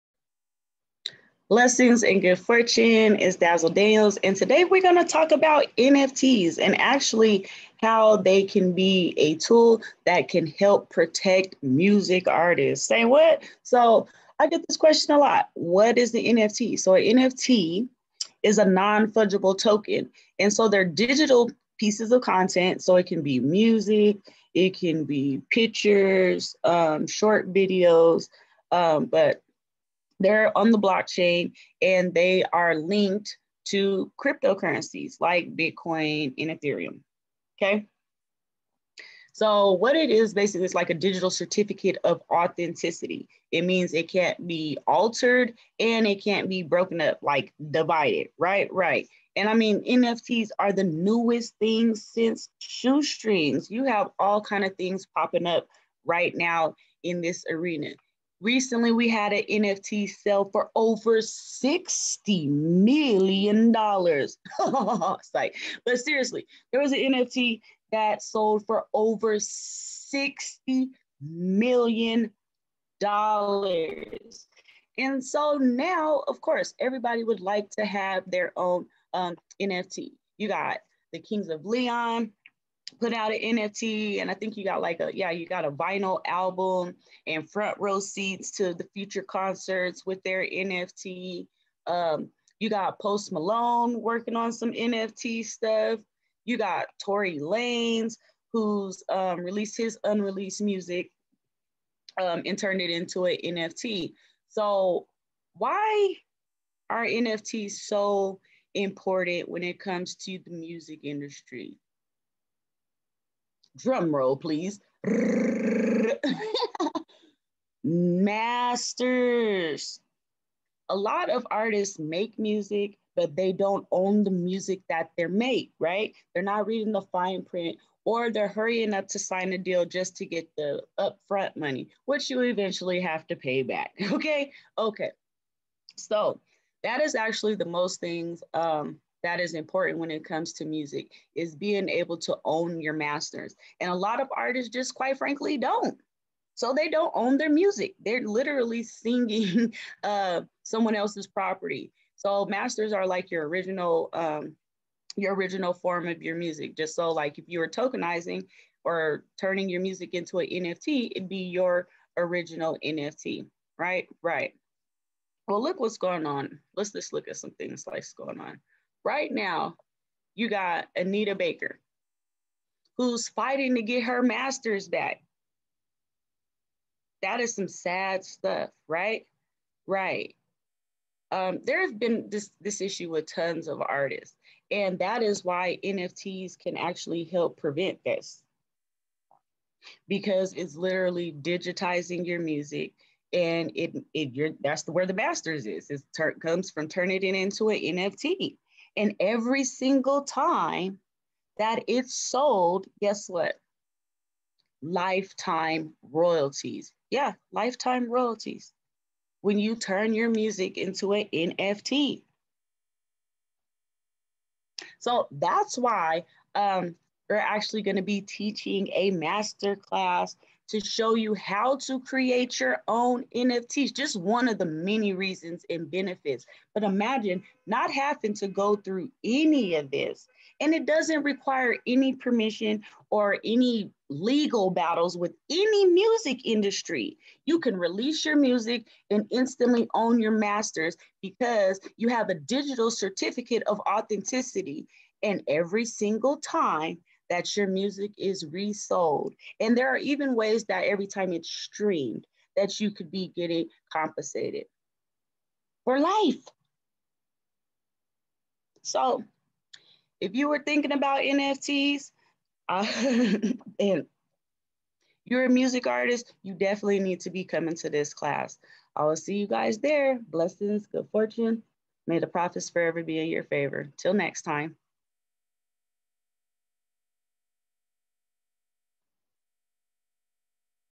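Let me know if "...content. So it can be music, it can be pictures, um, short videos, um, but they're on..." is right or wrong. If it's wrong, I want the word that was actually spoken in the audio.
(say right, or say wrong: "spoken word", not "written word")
right.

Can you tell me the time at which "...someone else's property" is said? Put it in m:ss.
2:30.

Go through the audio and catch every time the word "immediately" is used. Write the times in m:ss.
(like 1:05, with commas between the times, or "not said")
not said.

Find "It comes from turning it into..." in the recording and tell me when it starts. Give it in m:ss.
3:15.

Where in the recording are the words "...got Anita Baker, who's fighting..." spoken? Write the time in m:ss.
2:50.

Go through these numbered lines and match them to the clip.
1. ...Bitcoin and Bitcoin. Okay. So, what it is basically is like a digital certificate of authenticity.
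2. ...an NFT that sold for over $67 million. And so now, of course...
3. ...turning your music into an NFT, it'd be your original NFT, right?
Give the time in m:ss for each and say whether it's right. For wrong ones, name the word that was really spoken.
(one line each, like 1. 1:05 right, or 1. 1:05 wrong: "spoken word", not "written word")
1. 0:35 wrong: "Ethereum", not "Bitcoin"
2. 1:06 wrong: "60", not "67"
3. 2:39 right.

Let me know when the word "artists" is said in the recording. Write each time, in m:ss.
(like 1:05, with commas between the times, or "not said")
0:12, 2:01, 2:24, 3:03, 4:25.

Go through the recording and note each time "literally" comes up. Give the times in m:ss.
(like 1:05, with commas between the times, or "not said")
2:28, 3:10.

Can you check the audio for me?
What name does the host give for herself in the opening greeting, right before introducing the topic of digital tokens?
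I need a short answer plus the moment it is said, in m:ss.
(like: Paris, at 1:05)
Dazzle Daniels, at 0:03.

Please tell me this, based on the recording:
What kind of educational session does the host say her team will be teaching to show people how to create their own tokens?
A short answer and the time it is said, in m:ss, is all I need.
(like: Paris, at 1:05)
master class, at 3:39.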